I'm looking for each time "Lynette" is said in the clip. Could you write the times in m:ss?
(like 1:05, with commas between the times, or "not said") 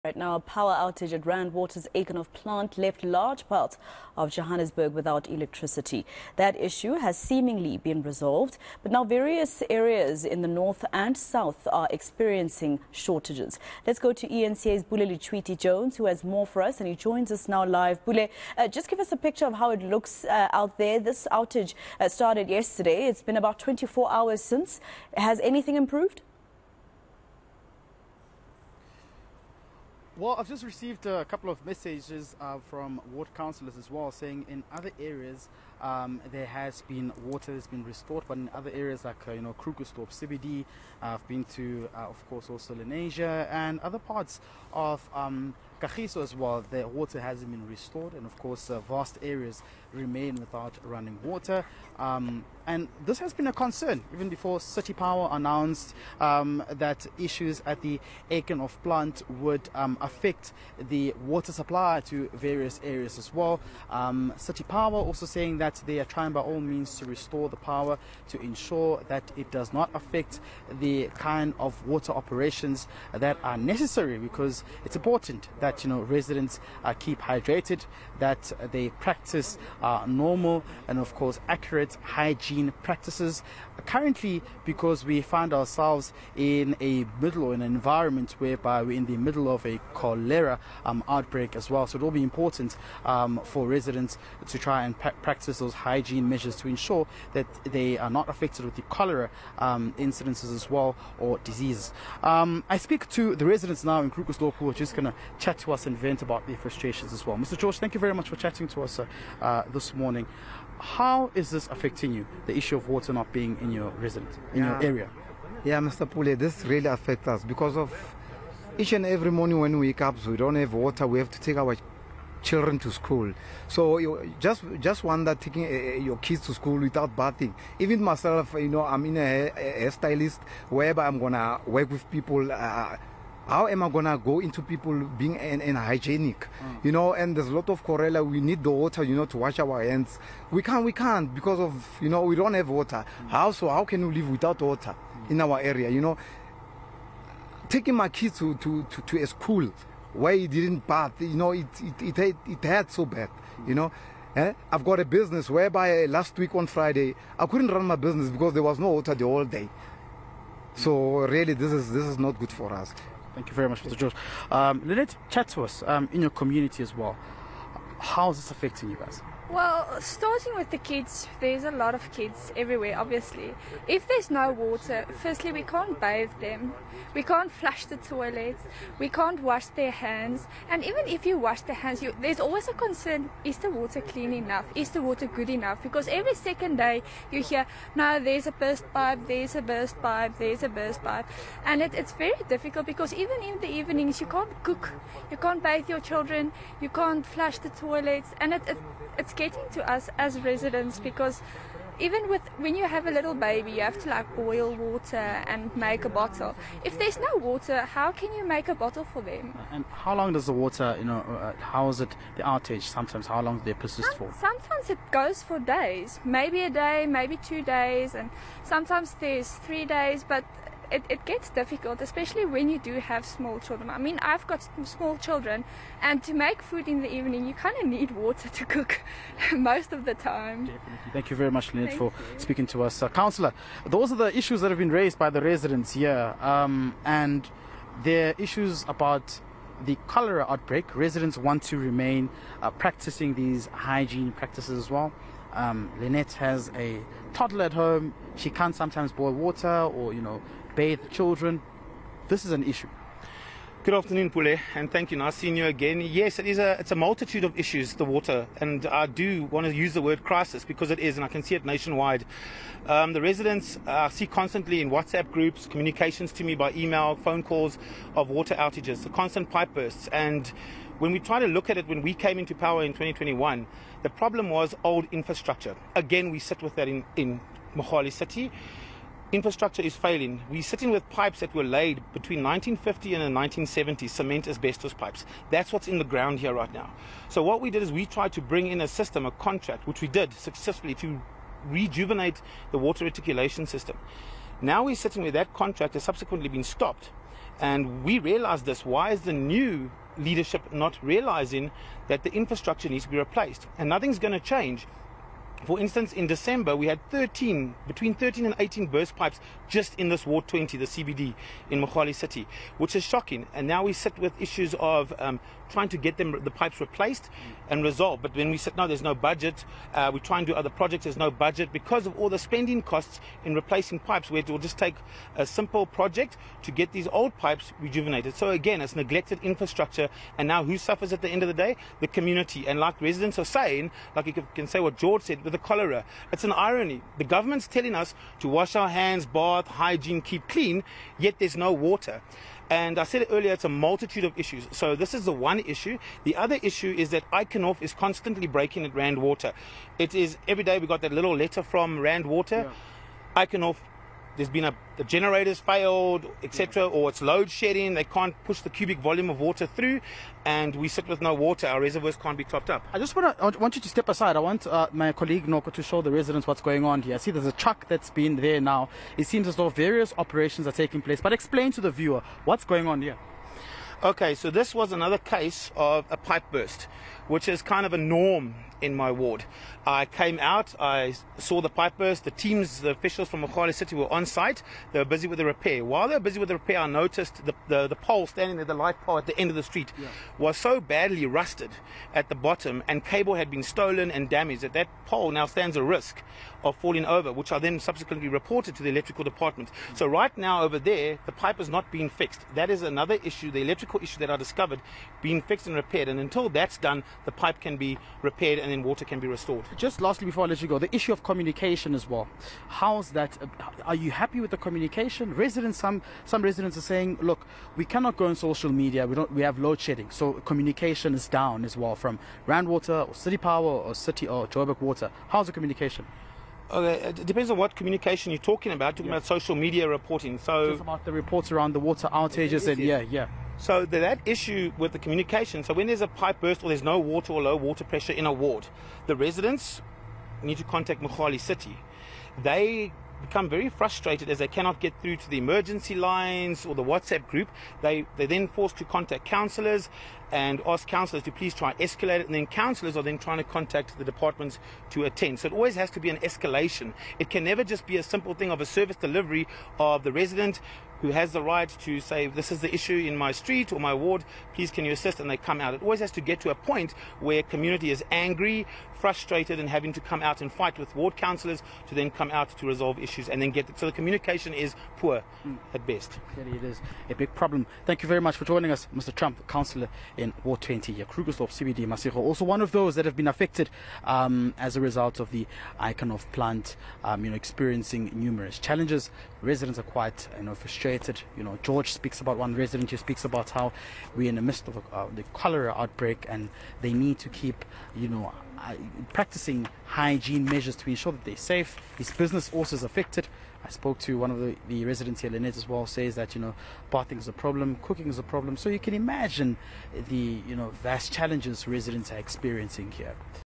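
2:44, 3:51, 4:05, 8:25.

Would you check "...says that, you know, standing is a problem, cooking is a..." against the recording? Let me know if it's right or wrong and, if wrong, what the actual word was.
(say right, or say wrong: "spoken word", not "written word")
wrong: "bathing", not "standing".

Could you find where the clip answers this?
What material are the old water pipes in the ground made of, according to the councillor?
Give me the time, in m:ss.
4:44.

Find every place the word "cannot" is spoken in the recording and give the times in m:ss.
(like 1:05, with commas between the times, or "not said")
6:57, 7:24.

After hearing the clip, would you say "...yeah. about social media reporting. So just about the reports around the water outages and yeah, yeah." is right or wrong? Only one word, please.
right.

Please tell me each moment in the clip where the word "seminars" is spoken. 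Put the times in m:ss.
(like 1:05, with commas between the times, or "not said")
not said.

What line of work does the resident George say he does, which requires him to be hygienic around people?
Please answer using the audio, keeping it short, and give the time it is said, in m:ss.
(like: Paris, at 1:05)
Stylist, at 2:09.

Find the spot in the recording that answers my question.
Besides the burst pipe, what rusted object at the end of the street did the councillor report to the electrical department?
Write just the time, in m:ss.
6:28.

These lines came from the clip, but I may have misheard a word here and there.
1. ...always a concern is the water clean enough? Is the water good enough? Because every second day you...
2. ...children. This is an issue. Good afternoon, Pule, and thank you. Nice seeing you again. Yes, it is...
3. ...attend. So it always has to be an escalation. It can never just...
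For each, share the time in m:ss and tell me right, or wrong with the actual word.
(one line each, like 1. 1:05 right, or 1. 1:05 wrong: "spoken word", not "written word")
1. 3:02 right
2. 4:11 right
3. 7:35 right.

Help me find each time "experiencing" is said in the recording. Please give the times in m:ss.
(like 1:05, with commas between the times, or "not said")
0:11, 8:07, 8:32.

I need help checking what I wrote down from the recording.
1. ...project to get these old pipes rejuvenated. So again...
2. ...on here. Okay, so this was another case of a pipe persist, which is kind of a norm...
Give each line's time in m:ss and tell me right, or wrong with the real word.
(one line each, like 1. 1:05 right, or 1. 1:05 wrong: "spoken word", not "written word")
1. 5:25 right
2. 6:12 wrong: "burst", not "persist".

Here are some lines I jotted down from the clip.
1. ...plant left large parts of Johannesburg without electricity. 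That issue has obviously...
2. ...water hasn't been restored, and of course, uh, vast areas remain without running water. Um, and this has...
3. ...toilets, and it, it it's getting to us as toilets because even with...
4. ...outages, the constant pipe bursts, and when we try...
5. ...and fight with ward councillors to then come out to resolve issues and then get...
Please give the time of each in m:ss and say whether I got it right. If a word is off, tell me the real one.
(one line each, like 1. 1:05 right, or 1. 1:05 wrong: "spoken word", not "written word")
1. 0:02 wrong: "seemingly", not "obviously"
2. 0:46 right
3. 3:17 wrong: "residents", not "toilets"
4. 4:28 right
5. 7:50 right.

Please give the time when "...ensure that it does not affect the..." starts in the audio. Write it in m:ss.
1:08.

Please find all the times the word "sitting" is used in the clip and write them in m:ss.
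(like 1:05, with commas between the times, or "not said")
4:40, 4:54.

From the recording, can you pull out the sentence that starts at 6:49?
Just lastly, before I let you go, the issue of communication as well.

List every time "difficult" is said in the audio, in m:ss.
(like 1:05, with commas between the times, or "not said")
3:12, 3:41.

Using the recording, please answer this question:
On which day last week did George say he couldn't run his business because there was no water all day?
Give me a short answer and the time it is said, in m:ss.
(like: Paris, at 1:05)
Friday, at 2:36.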